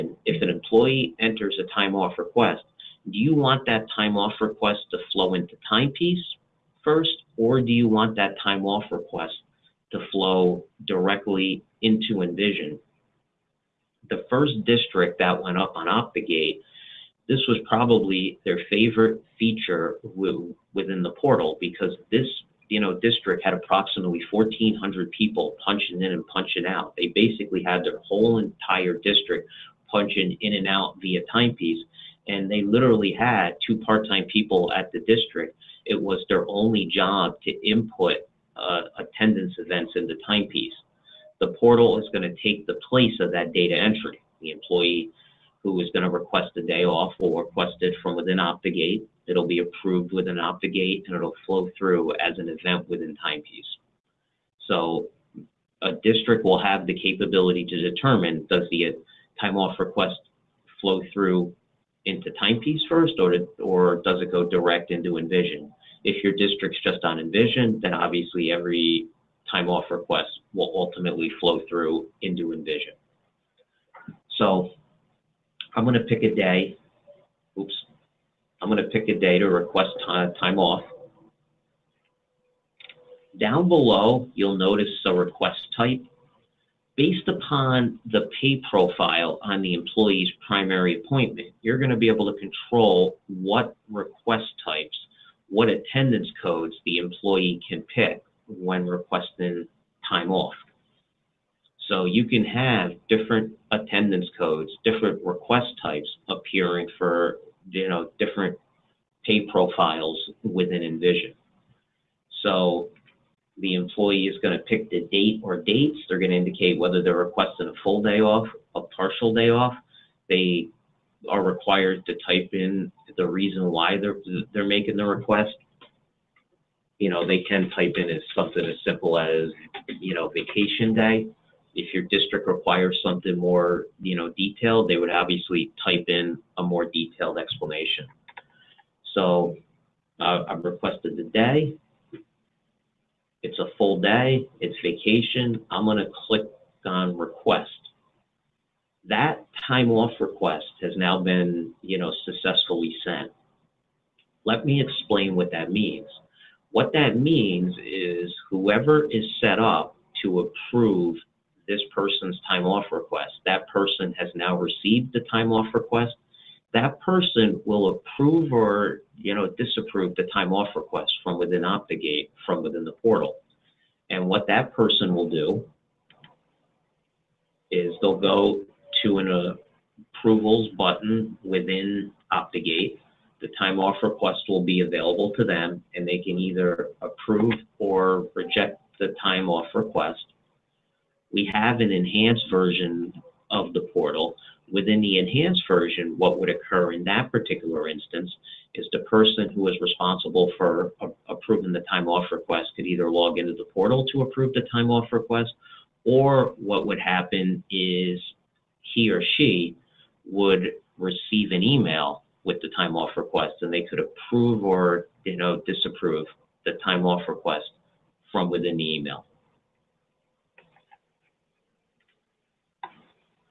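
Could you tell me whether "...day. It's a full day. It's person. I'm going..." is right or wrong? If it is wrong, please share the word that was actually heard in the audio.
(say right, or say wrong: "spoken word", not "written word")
wrong: "vacation", not "person".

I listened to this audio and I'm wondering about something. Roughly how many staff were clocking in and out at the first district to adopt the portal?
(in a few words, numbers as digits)
1,400.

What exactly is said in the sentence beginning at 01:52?
So the employee is going to pick the date or dates.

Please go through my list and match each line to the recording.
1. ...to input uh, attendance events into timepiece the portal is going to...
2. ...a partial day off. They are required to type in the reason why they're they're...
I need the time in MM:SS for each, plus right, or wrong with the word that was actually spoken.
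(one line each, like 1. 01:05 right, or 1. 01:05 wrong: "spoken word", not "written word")
1. 00:37 right
2. 01:58 right.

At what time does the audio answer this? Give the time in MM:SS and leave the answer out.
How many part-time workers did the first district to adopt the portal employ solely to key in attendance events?
00:33.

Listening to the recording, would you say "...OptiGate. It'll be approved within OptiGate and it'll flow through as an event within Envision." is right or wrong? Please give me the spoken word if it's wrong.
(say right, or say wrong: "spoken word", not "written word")
wrong: "Timepiece", not "Envision".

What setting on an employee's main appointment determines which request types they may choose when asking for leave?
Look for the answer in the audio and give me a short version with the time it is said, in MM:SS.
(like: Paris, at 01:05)
pay profile, at 01:28.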